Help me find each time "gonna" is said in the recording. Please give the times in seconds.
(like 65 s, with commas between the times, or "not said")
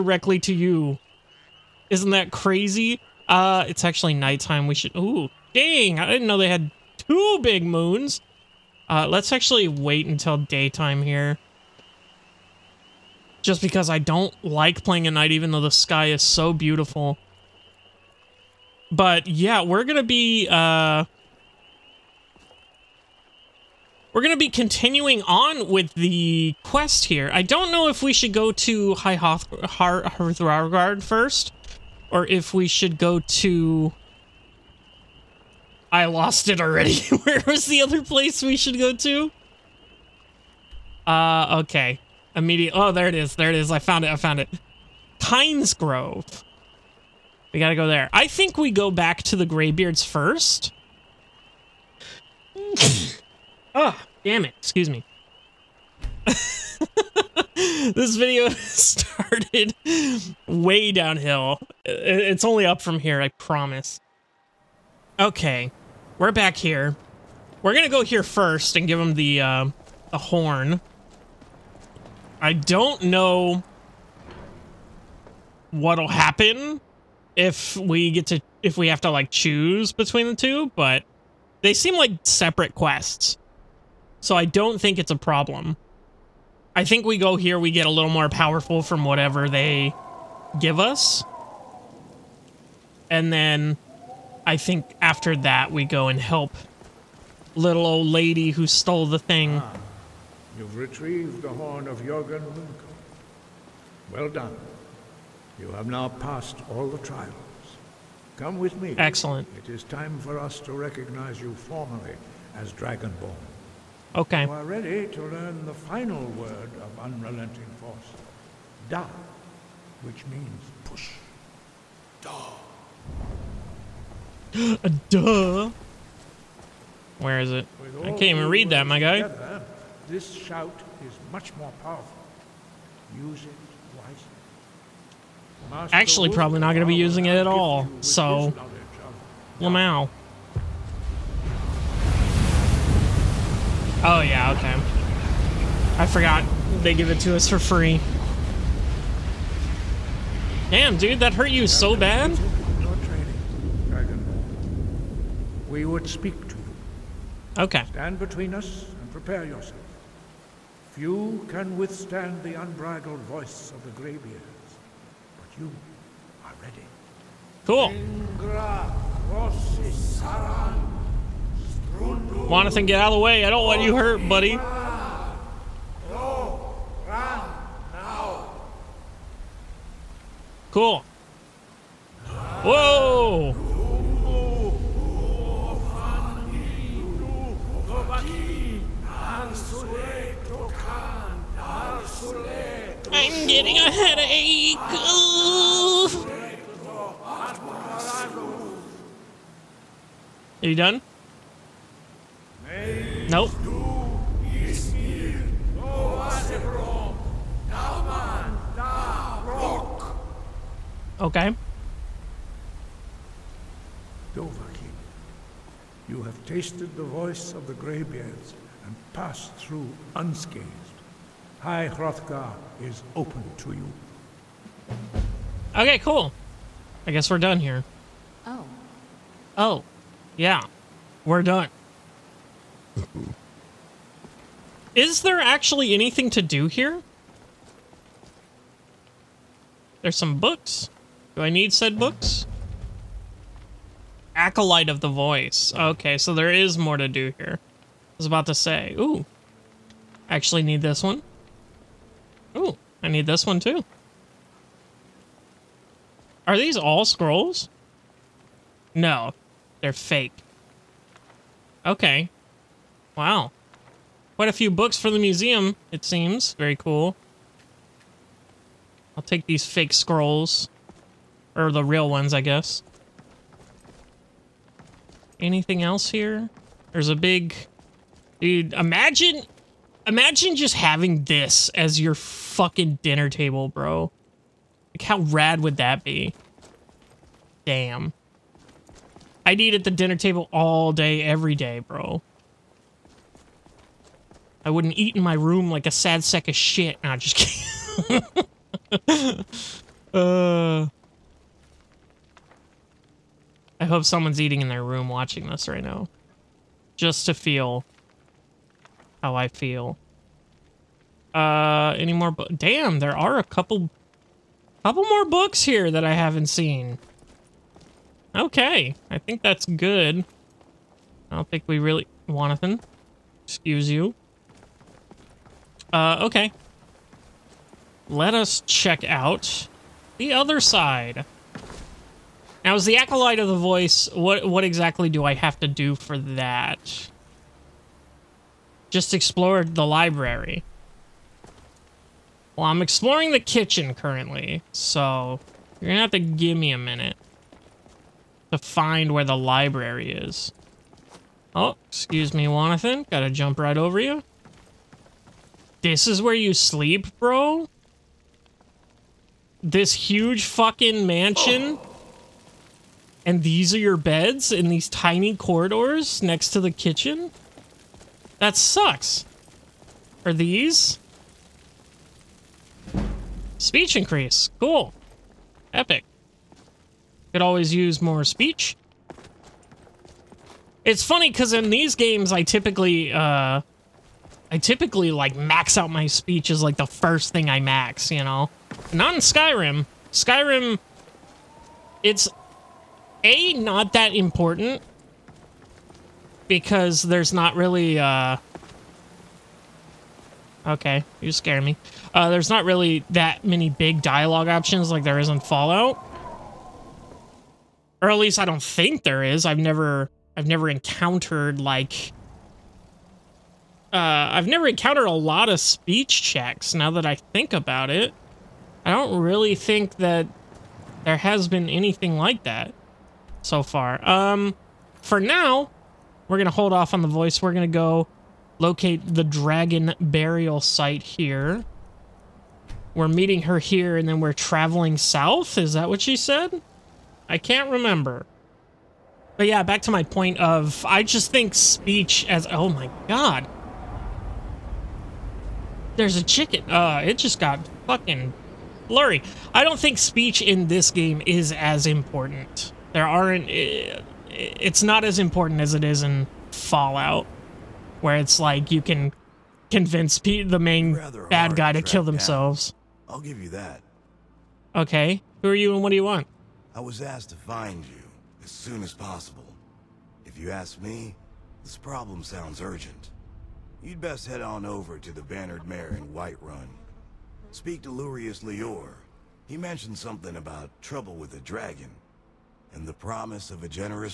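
67 s, 345 s.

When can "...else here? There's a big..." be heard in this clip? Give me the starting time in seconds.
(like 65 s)
275 s.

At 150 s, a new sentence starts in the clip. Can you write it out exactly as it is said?
Damn, dude, that hurt you so bad?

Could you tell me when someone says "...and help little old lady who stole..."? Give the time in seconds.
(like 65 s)
96 s.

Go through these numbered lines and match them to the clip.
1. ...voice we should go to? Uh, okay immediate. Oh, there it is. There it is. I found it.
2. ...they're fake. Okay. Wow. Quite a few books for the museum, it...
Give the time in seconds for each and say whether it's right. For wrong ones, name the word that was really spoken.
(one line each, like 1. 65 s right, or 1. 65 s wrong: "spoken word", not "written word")
1. 38 s wrong: "place", not "voice"
2. 259 s right.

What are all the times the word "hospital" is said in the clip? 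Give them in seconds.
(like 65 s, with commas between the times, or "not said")
not said.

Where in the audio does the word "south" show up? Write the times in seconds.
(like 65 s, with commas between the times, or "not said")
434 s.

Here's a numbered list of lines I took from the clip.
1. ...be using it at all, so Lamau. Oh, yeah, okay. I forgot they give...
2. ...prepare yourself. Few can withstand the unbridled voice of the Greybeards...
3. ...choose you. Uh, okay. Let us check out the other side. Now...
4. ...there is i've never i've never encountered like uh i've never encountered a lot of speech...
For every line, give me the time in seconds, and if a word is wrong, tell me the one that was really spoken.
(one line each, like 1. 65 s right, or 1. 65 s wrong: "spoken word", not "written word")
1. 136 s right
2. 159 s right
3. 323 s wrong: "excuse", not "choose"
4. 409 s right.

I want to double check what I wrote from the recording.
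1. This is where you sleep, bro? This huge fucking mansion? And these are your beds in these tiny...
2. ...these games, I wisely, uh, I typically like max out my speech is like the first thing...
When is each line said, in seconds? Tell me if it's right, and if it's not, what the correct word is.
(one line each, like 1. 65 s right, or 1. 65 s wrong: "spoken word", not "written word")
1. 355 s right
2. 381 s wrong: "typically", not "wisely".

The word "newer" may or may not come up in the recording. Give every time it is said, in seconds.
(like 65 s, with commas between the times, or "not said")
not said.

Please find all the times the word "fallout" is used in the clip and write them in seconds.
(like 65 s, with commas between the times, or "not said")
405 s, 456 s.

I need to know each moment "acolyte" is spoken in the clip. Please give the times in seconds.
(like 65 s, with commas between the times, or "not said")
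244 s, 332 s.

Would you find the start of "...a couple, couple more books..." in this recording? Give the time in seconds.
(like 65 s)
313 s.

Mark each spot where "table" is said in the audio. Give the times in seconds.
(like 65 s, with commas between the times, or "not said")
283 s, 290 s.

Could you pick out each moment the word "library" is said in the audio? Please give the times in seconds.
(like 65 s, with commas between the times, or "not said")
339 s, 349 s.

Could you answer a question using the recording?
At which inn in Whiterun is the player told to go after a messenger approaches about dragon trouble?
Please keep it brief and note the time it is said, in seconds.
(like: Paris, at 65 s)
The Bannered Mare, at 475 s.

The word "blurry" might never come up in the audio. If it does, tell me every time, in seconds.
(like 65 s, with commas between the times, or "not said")
448 s.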